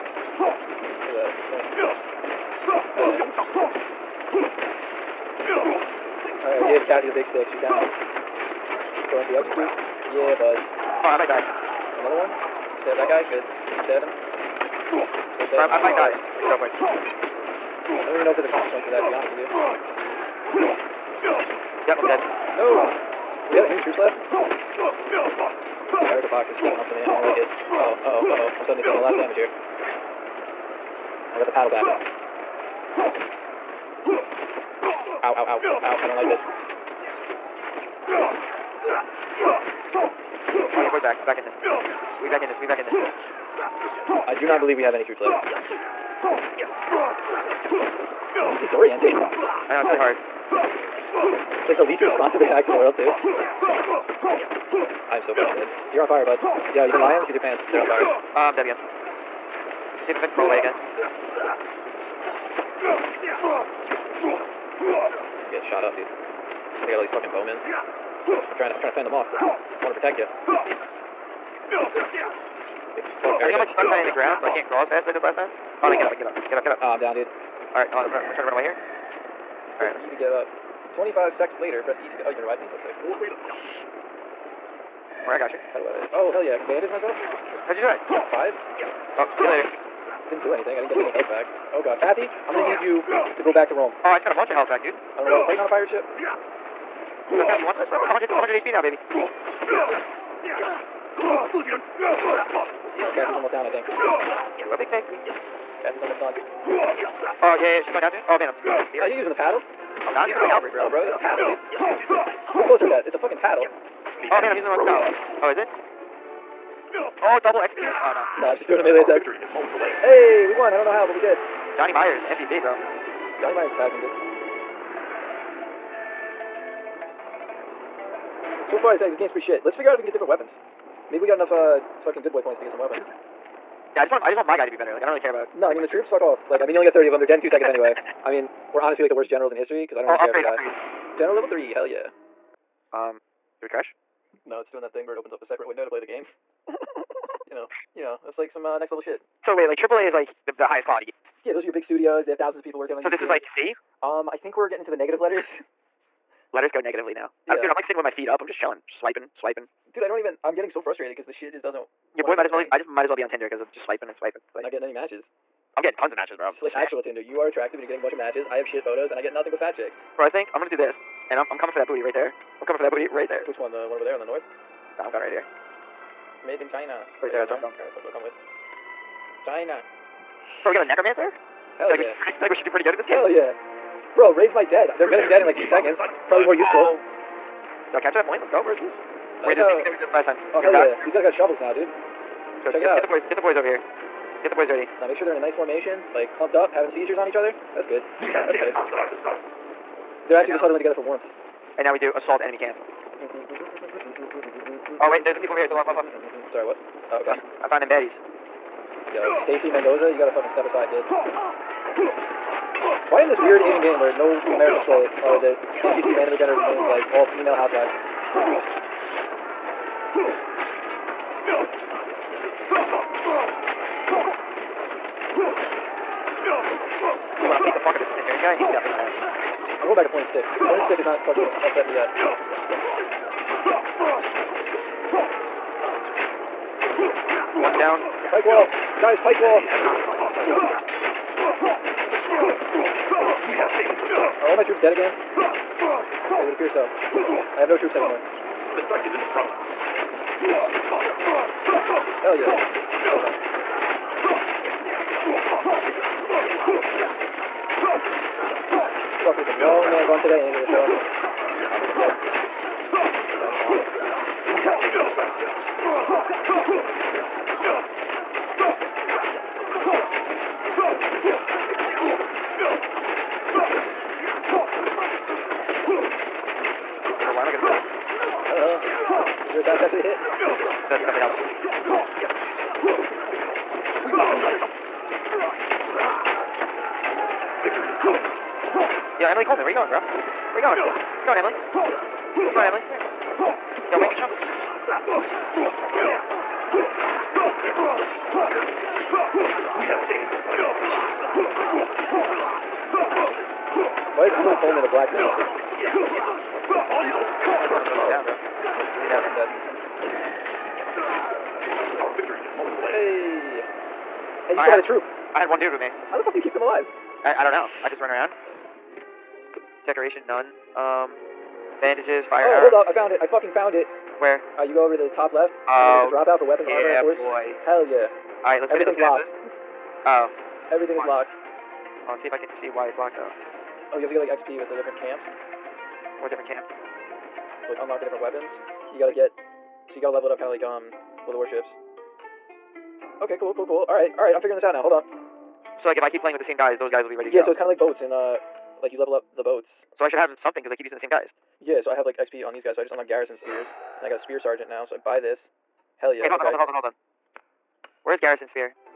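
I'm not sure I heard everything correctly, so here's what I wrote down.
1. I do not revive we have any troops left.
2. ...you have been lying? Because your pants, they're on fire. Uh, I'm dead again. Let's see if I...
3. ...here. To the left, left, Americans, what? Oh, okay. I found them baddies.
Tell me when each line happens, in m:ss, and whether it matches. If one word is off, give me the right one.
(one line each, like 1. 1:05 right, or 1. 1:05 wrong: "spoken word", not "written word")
1. 0:44 wrong: "believe", not "revive"
2. 0:56 right
3. 3:25 wrong: "Sorry", not "Americans".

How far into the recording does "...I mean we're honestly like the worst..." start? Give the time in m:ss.
2:18.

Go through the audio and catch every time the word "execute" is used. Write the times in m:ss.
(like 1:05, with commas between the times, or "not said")
0:09, 1:57.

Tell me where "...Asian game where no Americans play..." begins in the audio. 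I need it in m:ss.
3:33.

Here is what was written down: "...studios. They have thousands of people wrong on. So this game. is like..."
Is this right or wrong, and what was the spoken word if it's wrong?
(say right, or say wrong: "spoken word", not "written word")
wrong: "working", not "wrong".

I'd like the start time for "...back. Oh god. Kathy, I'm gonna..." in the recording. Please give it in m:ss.
1:31.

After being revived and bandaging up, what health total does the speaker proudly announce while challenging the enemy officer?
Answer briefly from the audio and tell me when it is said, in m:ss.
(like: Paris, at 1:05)
100 HP, at 1:38.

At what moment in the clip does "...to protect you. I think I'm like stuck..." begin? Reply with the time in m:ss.
1:09.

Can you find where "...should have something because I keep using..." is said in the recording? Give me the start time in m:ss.
5:50.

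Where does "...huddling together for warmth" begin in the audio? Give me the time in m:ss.
3:20.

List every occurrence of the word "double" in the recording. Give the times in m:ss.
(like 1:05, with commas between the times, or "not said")
1:57.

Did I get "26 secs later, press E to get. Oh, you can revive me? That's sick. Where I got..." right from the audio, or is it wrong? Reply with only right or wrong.
wrong.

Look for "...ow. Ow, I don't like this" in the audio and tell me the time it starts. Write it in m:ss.
0:35.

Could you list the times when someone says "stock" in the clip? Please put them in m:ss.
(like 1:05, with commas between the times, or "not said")
not said.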